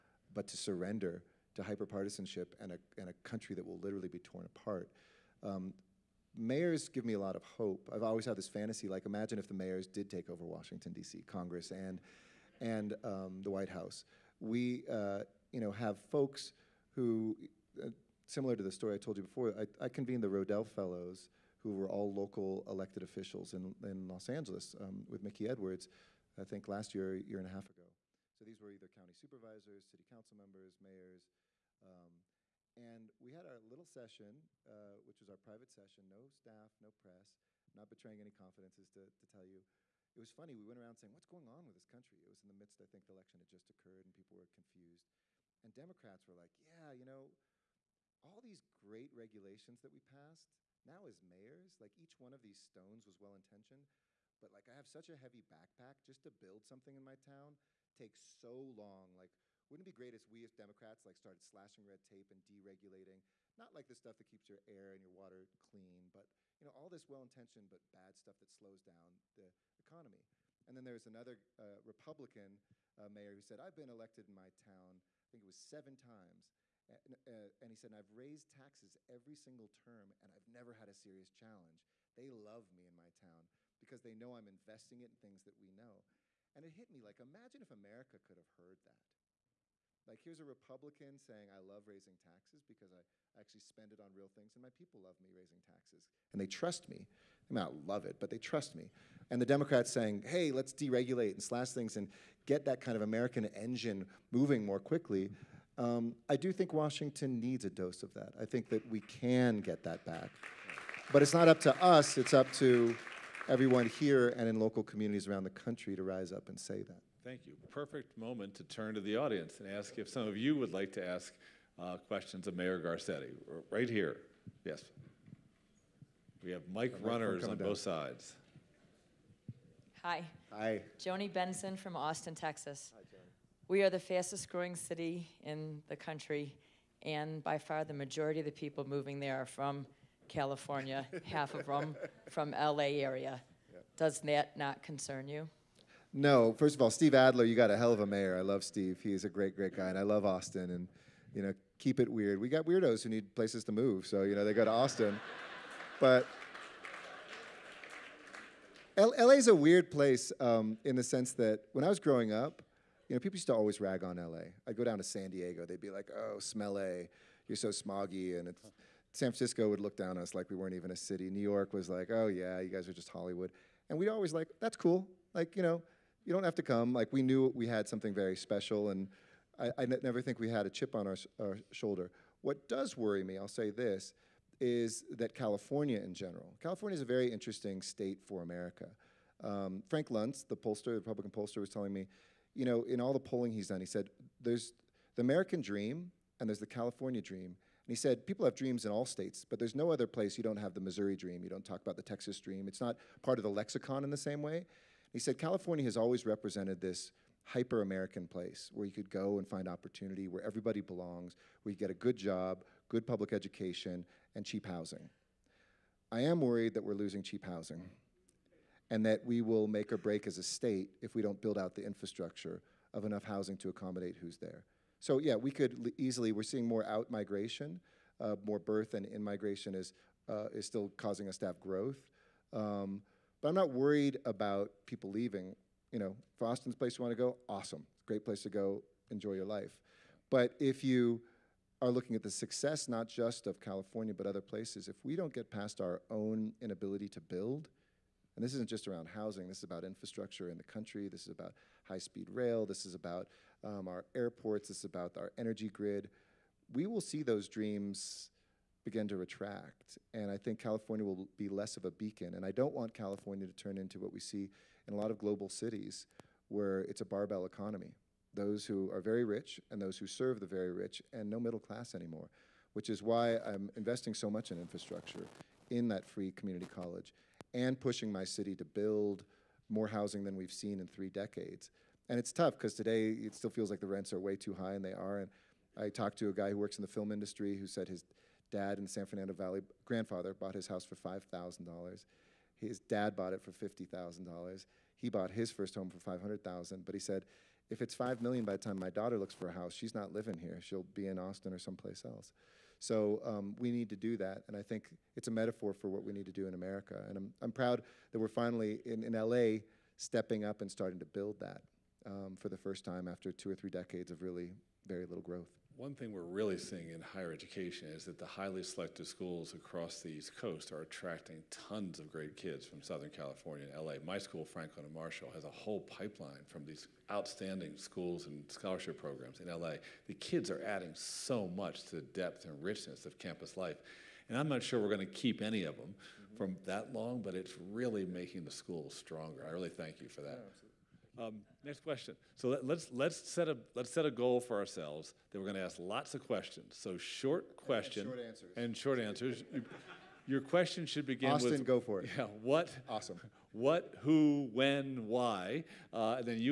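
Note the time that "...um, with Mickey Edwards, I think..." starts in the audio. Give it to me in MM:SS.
00:24.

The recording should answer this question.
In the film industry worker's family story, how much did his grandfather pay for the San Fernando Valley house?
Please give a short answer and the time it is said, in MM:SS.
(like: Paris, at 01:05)
$5,000, at 04:50.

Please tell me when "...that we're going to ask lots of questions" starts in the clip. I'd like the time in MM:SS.
05:45.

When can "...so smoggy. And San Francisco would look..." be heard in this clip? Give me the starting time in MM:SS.
02:47.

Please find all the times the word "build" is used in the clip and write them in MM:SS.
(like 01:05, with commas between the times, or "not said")
00:56, 03:41, 04:07, 04:38, 05:11.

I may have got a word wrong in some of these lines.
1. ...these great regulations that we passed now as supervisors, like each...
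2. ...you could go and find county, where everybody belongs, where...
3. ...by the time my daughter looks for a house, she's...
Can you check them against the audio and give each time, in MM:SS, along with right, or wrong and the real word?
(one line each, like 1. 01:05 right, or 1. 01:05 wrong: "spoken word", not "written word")
1. 00:48 wrong: "mayors", not "supervisors"
2. 03:28 wrong: "opportunity", not "county"
3. 04:58 right.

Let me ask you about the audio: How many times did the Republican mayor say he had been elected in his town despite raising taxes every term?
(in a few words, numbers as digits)
7.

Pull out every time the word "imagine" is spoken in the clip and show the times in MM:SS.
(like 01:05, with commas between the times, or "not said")
00:09, 01:27.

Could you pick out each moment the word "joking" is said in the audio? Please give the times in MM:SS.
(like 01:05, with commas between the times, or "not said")
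not said.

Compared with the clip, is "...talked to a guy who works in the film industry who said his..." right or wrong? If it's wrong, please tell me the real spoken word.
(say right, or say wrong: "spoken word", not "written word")
right.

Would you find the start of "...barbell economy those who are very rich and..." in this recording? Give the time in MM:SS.
04:27.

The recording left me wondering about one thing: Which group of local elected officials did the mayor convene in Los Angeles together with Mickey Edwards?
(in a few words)
Rodel Fellows.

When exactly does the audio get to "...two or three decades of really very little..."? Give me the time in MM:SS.
05:13.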